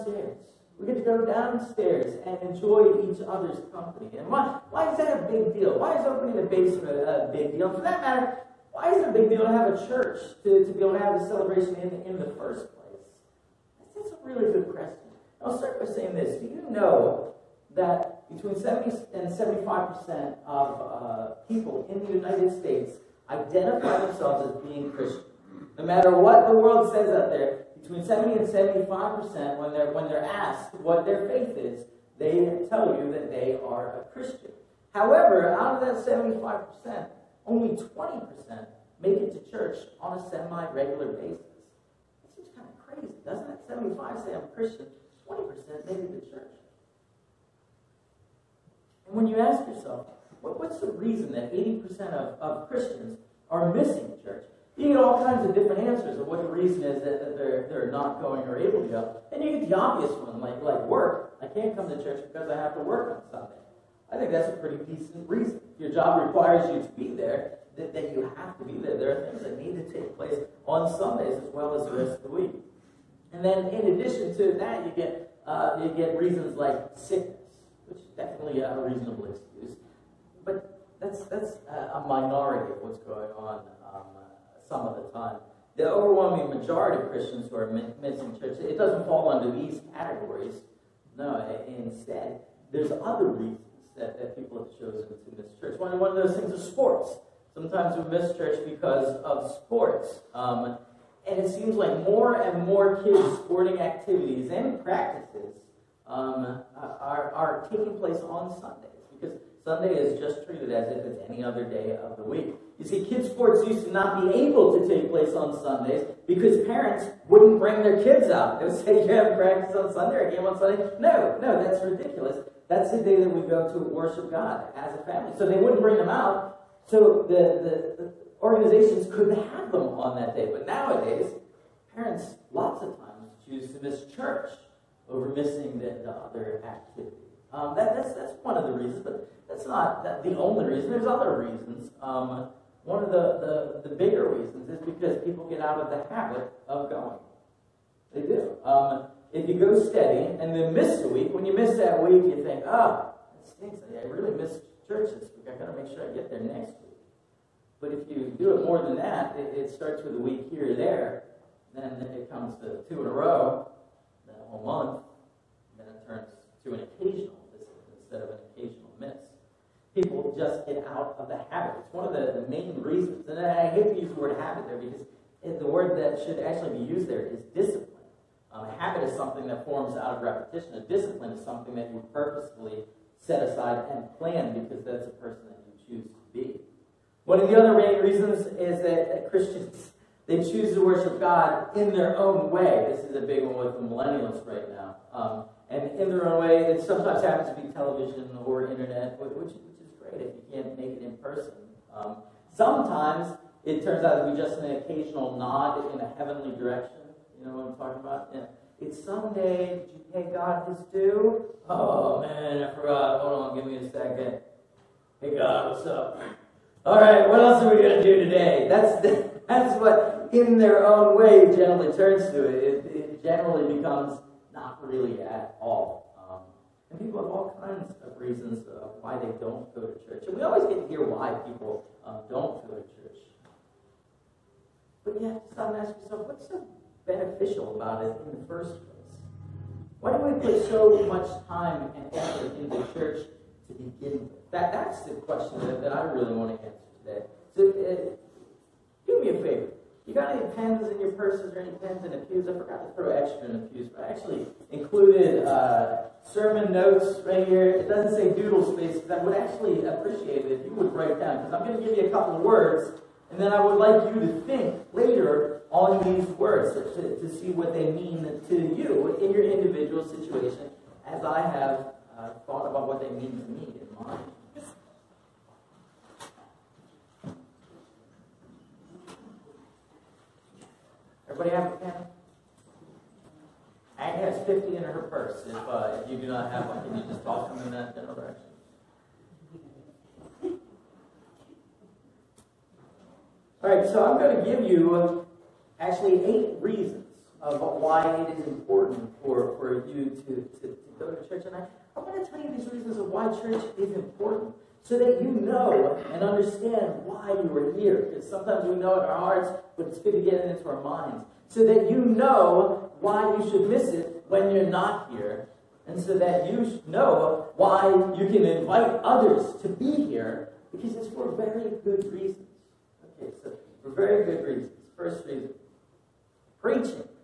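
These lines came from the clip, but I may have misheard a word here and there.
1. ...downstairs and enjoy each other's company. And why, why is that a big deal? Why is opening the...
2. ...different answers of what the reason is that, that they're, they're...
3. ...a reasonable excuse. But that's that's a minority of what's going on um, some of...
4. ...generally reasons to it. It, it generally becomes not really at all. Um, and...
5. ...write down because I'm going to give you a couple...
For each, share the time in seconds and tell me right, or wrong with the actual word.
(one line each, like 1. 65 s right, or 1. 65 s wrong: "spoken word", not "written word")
1. 1 s right
2. 55 s right
3. 78 s right
4. 221 s wrong: "turns", not "reasons"
5. 260 s right.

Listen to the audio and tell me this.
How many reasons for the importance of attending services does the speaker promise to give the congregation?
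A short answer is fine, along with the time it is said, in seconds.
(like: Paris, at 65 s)
8, at 296 s.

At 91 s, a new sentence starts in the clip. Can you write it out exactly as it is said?
No, instead, there's other reasons that, that people have chosen to miss church.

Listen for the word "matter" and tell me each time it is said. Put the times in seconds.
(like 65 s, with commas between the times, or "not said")
8 s, 25 s.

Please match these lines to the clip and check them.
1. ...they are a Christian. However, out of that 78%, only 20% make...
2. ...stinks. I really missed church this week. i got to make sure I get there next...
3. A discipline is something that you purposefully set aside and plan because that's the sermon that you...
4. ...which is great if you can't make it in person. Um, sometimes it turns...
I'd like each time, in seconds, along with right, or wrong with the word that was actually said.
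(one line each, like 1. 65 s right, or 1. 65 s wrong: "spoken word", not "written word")
1. 33 s wrong: "75", not "78"
2. 153 s right
3. 180 s wrong: "person", not "sermon"
4. 199 s right.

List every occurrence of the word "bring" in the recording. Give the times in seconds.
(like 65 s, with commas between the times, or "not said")
117 s, 125 s.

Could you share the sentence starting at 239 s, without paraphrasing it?
Why do we put so much time and effort into the church to begin with?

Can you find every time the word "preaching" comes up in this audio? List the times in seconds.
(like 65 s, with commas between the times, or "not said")
326 s.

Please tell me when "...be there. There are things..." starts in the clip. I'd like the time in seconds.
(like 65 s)
68 s.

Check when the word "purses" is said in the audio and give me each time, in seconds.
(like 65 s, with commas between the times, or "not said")
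251 s, 285 s.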